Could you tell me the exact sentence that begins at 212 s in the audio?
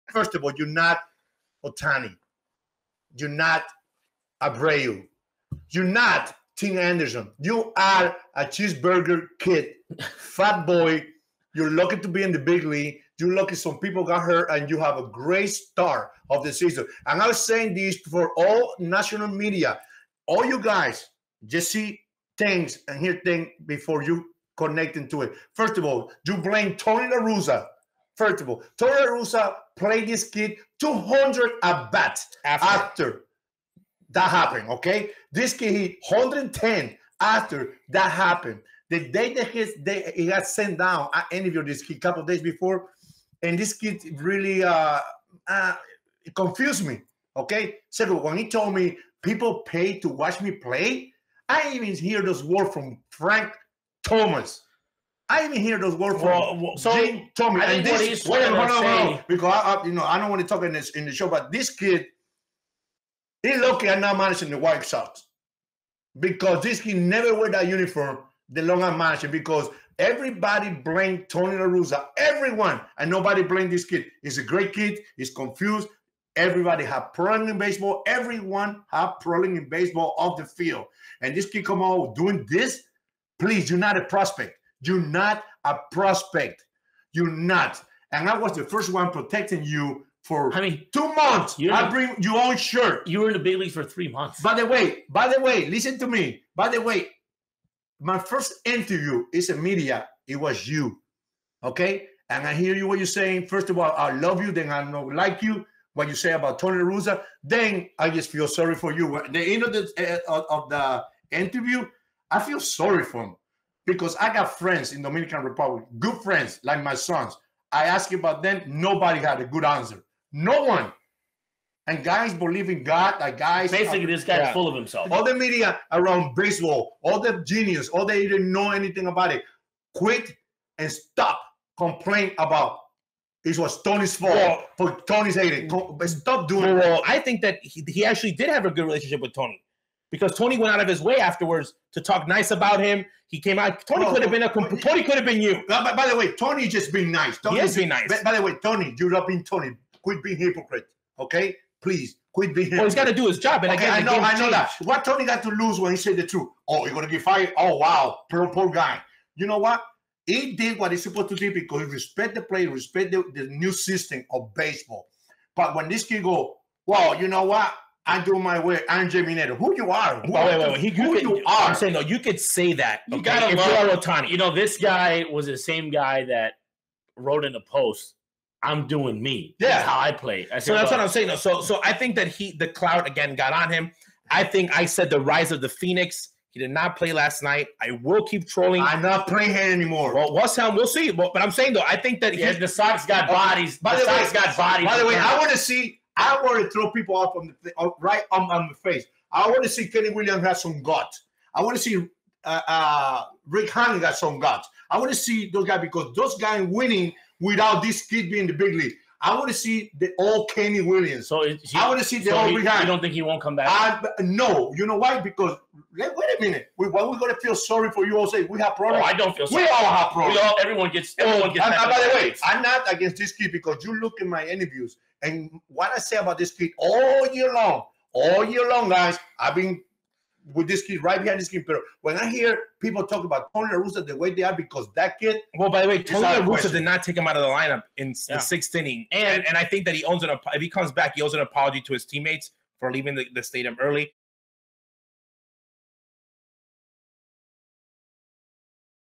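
You don't think he won't come back?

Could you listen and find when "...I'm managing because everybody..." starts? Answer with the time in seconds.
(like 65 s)
68 s.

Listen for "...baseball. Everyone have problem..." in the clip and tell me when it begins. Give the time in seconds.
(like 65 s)
77 s.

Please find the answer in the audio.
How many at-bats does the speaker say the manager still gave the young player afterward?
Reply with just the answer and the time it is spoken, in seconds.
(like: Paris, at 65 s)
200, at 30 s.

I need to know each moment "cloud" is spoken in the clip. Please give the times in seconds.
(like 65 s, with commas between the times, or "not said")
182 s.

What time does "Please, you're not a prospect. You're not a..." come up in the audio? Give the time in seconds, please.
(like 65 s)
83 s.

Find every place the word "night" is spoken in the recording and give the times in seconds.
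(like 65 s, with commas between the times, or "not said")
187 s.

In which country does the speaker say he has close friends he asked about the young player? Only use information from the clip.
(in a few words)
Dominican Republic.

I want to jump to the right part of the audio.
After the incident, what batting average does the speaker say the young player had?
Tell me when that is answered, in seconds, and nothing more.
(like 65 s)
36 s.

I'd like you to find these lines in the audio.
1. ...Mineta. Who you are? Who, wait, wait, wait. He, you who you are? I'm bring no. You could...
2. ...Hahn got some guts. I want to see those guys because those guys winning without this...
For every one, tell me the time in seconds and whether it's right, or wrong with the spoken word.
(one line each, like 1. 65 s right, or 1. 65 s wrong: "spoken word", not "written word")
1. 169 s wrong: "saying", not "bring"
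2. 203 s right.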